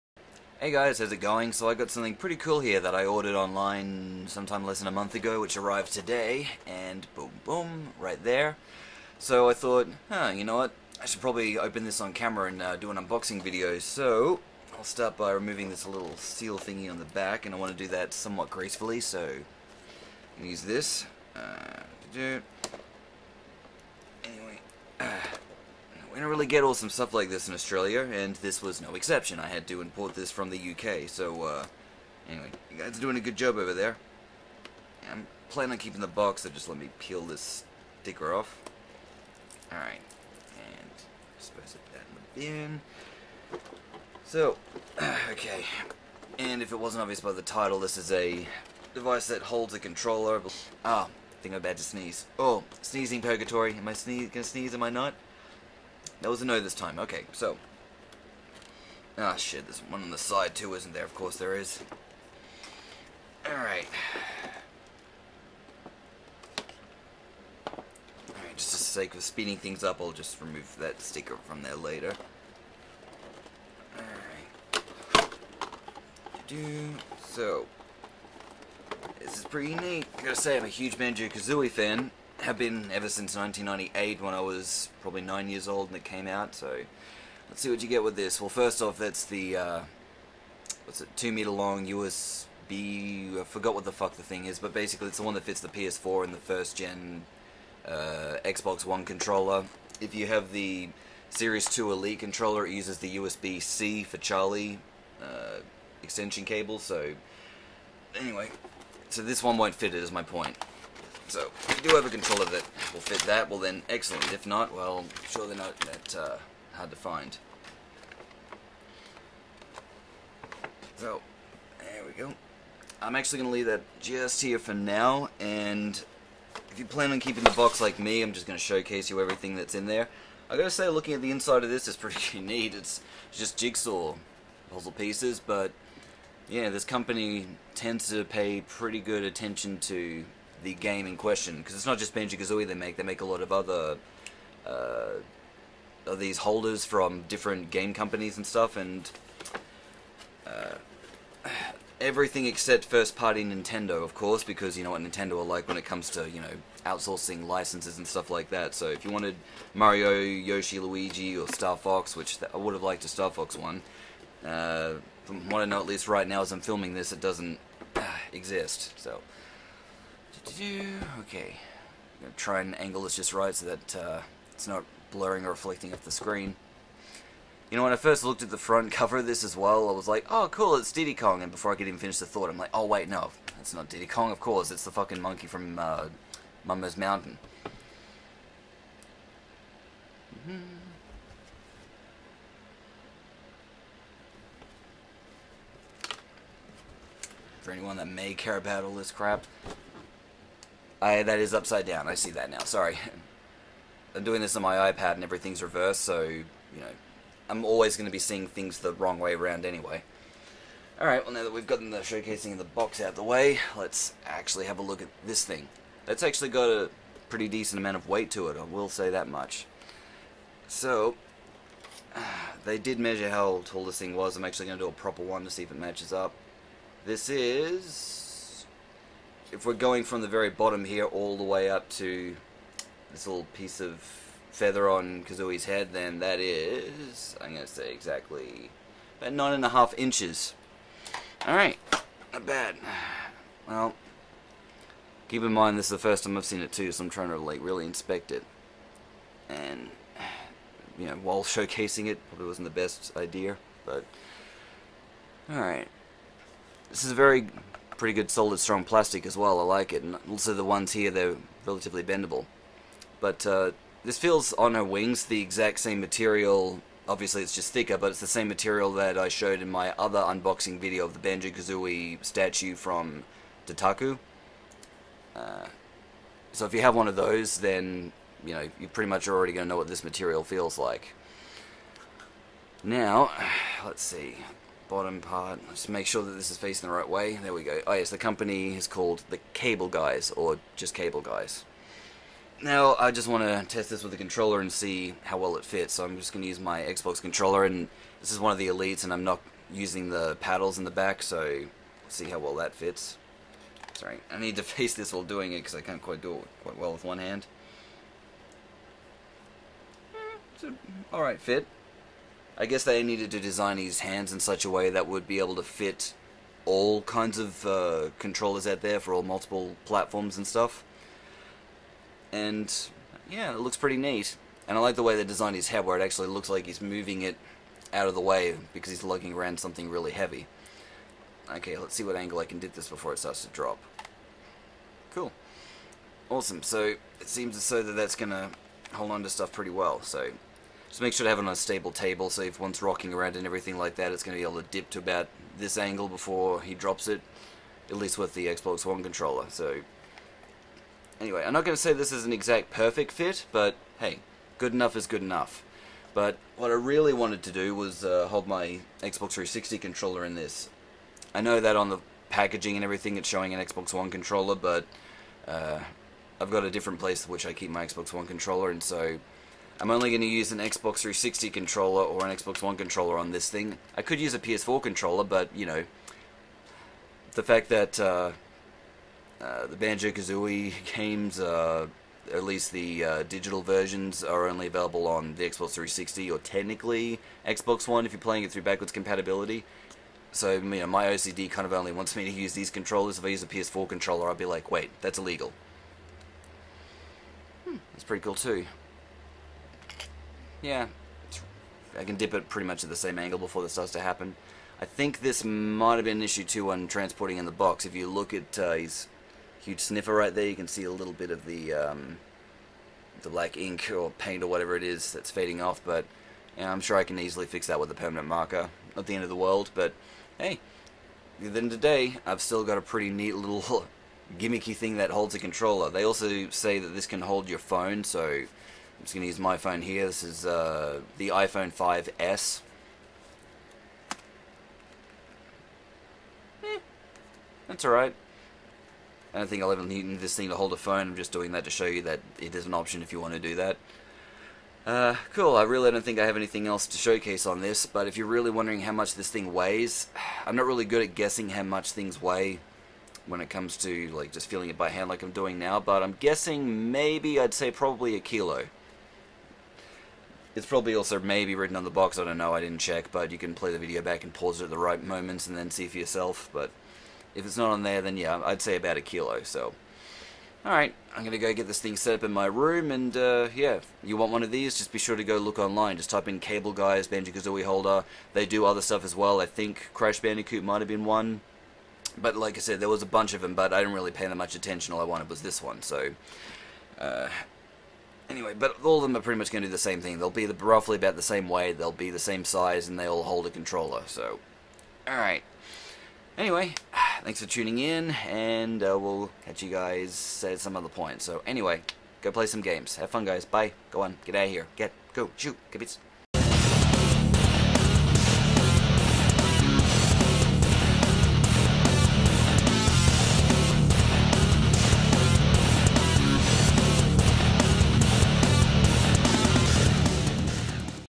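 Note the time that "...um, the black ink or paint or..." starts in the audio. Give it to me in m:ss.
6:51.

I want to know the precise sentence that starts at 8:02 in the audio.
But like I said, there was a bunch of them, but I didn't really pay that much attention.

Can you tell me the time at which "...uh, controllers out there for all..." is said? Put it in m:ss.
5:17.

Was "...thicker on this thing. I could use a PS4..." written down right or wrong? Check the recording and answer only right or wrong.
wrong.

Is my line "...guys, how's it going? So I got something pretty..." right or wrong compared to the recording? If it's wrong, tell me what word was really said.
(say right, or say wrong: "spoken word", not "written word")
right.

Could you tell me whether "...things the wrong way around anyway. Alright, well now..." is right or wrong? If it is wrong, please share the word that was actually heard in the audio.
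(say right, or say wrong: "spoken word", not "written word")
right.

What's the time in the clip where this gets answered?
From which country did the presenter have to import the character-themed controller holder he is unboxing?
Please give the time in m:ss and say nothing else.
0:30.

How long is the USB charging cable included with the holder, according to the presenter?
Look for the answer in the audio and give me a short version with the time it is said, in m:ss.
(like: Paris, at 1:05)
2 meters, at 1:31.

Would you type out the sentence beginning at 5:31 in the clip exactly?
Okay, let's see what angle I can get this before it starts to drop.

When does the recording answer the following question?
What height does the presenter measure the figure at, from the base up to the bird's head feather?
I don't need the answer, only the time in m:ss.
3:59.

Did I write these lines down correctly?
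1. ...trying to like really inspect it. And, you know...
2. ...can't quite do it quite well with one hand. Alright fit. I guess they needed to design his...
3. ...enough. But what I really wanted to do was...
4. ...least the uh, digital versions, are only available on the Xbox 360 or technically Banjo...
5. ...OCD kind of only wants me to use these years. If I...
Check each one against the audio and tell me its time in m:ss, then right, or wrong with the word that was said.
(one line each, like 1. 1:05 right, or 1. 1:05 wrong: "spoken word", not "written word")
1. 4:07 right
2. 5:05 right
3. 5:55 right
4. 6:22 wrong: "Xbox", not "Banjo"
5. 6:31 wrong: "controllers", not "years".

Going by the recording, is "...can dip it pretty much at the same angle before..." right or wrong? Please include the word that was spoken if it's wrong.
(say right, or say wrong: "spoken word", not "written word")
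right.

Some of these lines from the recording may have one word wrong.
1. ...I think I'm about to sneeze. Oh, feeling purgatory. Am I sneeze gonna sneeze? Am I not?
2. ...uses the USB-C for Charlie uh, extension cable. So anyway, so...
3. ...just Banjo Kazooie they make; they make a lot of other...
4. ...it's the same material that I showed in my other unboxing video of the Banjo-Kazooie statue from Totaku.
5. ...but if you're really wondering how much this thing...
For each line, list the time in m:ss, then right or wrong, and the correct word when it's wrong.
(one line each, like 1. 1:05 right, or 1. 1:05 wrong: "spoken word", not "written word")
1. 0:51 wrong: "sneezing", not "feeling"
2. 1:42 right
3. 2:21 right
4. 4:28 right
5. 7:27 right.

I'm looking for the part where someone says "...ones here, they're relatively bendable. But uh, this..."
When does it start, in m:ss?
4:20.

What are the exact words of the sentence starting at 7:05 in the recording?
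They also say that this can hold your phone, so I'm just going to use my phone here.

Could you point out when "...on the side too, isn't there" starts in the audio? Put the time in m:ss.
1:00.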